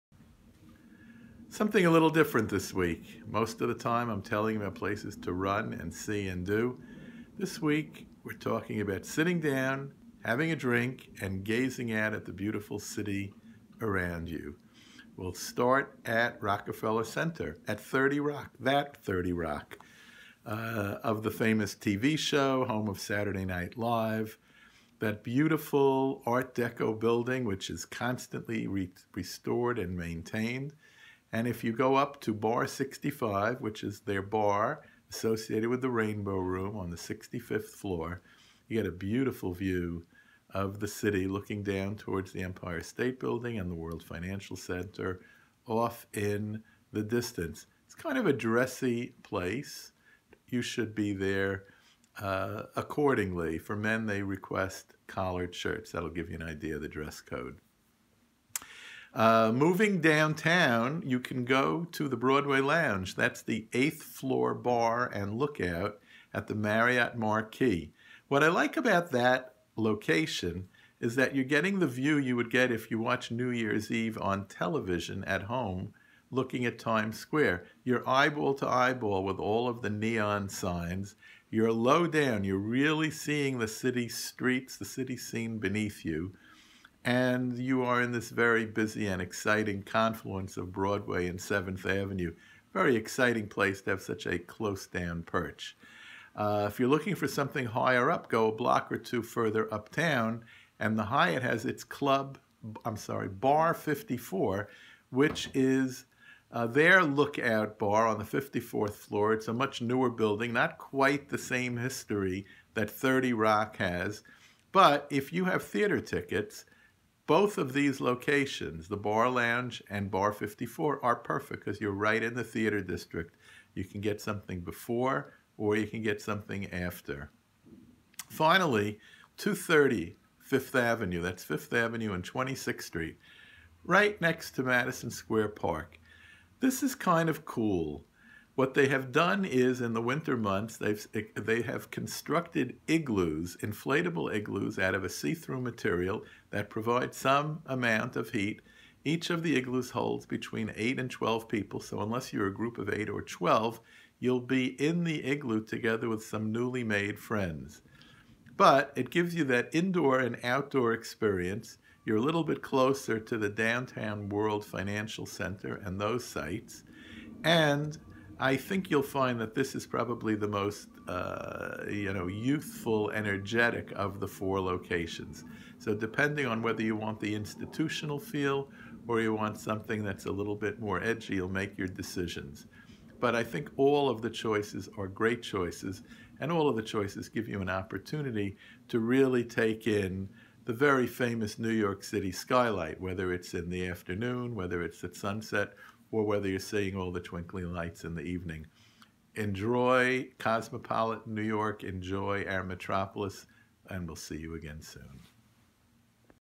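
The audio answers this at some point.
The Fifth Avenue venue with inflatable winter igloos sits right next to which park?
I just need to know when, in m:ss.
2:14.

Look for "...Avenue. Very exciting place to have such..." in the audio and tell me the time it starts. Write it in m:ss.
1:31.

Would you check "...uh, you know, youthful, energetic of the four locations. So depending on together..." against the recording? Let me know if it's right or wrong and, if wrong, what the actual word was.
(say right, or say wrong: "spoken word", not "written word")
wrong: "whether", not "together".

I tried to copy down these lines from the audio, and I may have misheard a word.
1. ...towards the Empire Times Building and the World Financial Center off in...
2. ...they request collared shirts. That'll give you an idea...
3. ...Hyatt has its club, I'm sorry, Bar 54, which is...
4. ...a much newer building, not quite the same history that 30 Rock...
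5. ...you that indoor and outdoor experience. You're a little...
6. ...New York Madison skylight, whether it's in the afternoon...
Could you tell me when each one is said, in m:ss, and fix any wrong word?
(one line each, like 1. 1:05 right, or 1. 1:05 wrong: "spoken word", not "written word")
1. 0:41 wrong: "State", not "Times"
2. 0:54 right
3. 1:41 right
4. 1:49 right
5. 2:39 right
6. 3:11 wrong: "City", not "Madison".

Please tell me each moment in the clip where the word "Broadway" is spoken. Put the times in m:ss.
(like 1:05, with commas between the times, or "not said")
1:02, 1:30.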